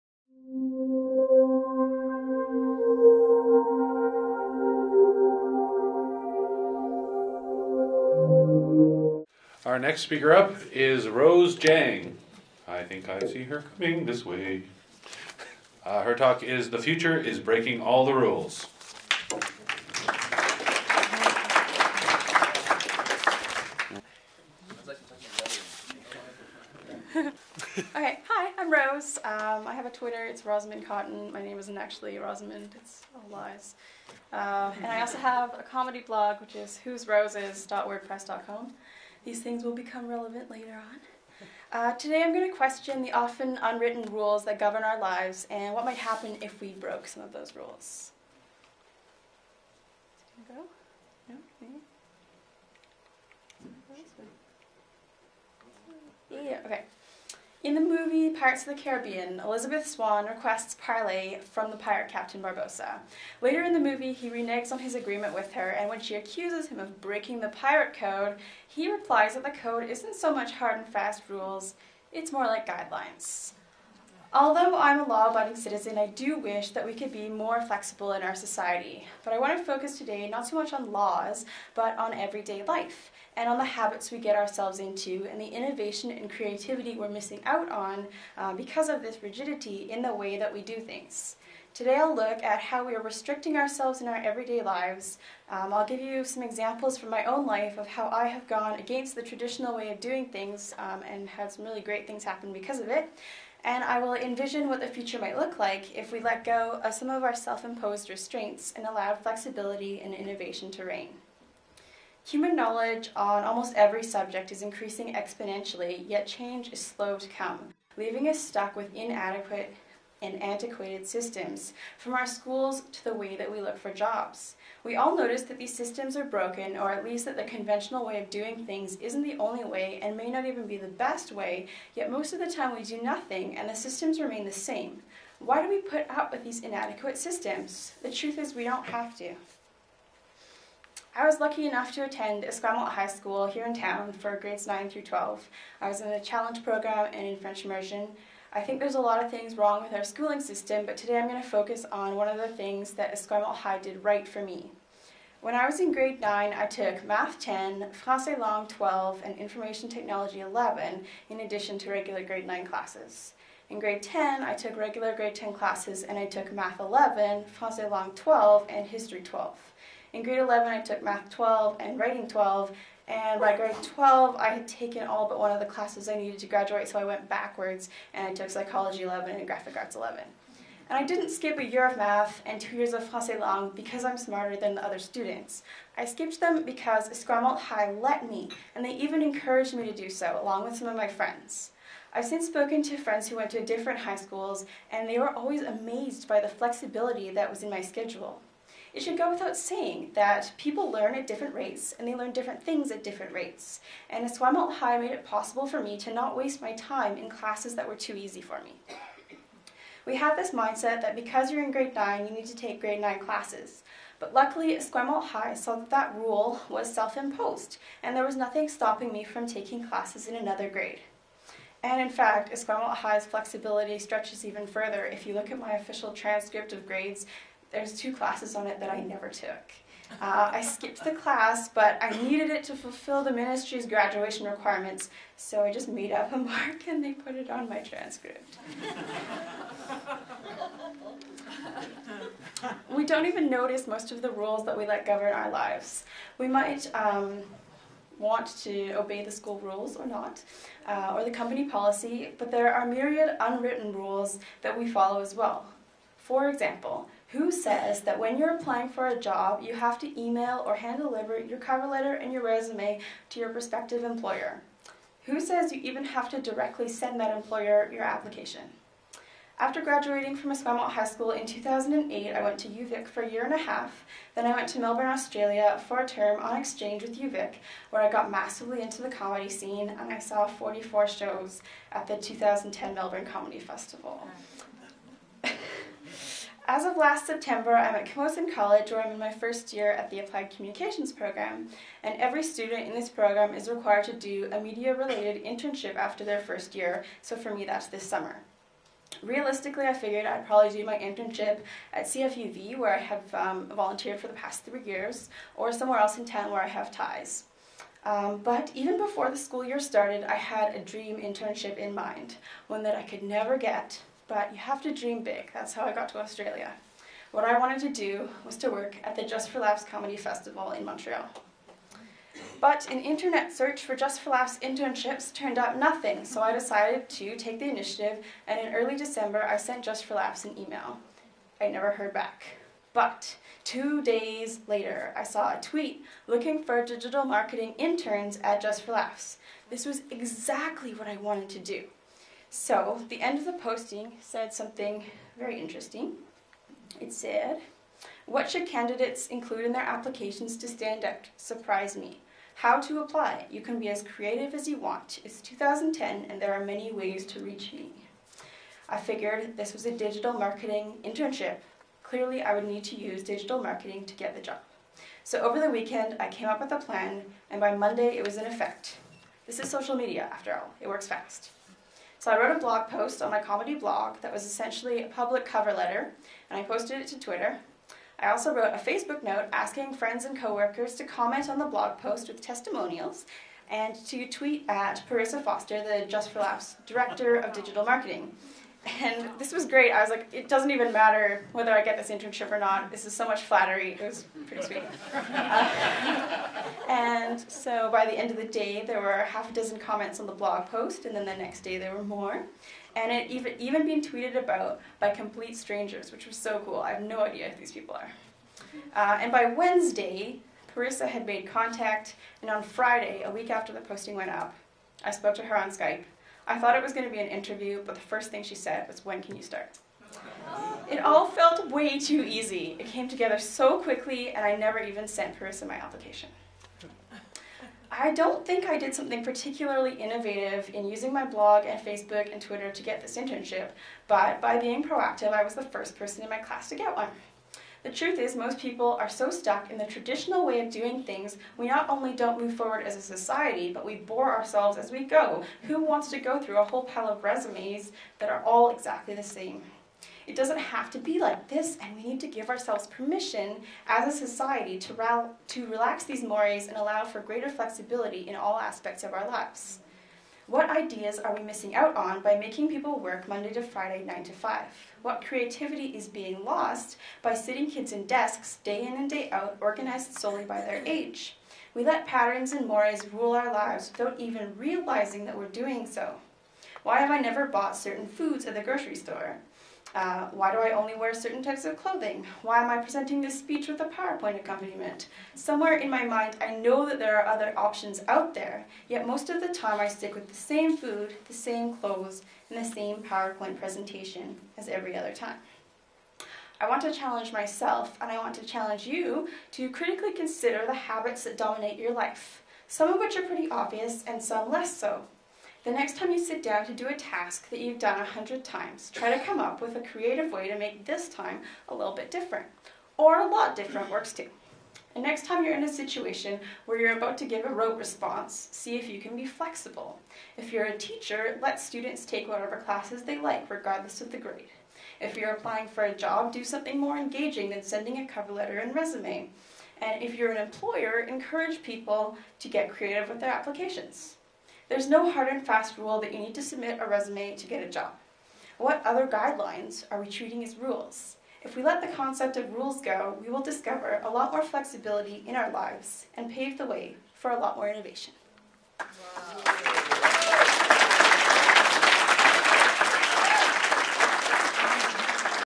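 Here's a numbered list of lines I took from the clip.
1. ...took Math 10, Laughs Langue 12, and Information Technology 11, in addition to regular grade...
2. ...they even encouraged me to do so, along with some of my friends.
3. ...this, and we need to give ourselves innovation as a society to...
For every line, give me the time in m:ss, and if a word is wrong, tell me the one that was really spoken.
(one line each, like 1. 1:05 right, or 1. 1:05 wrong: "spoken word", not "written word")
1. 2:36 wrong: "Français", not "Laughs"
2. 3:08 right
3. 7:31 wrong: "permission", not "innovation".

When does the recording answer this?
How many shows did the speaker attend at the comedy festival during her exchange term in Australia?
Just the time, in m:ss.
4:40.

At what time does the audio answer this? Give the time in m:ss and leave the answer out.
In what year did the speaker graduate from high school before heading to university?
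4:31.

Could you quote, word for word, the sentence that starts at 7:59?
Uh, why do I only wear certain types of clothing?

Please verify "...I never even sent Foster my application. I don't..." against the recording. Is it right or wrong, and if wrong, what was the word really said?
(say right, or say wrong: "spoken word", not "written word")
wrong: "Parissa", not "Foster".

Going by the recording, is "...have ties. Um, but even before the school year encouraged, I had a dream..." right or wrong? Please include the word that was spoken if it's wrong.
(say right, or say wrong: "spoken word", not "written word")
wrong: "started", not "encouraged".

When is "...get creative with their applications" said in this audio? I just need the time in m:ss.
8:52.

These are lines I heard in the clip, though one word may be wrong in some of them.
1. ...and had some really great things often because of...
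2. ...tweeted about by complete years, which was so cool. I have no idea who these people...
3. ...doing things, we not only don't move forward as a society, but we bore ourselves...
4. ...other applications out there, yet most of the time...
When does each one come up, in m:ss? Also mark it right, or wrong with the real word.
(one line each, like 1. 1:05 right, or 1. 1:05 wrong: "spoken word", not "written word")
1. 1:41 wrong: "happen", not "often"
2. 6:44 wrong: "strangers", not "years"
3. 7:20 right
4. 8:07 wrong: "options", not "applications".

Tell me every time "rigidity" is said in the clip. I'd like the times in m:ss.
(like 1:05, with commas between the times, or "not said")
1:29.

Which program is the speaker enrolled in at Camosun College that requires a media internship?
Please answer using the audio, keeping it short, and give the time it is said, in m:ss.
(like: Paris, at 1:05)
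Applied Communications, at 4:50.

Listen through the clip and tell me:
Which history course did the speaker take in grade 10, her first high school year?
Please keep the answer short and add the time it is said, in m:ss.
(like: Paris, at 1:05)
History 12, at 2:48.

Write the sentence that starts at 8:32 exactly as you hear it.
Or a lot different works too.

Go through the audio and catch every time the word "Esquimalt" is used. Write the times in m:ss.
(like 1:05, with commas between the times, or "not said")
2:22, 2:33, 3:07, 3:24, 3:34, 3:42, 4:30.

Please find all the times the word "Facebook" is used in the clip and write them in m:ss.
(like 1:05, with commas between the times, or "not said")
6:18, 7:11.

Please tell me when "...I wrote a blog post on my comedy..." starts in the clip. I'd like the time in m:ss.
6:12.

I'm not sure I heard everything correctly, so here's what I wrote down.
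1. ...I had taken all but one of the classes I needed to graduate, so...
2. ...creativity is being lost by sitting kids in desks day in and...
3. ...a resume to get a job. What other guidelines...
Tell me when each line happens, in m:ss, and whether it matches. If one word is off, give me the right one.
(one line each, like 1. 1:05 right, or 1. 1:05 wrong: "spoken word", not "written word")
1. 2:54 right
2. 7:45 right
3. 8:56 right.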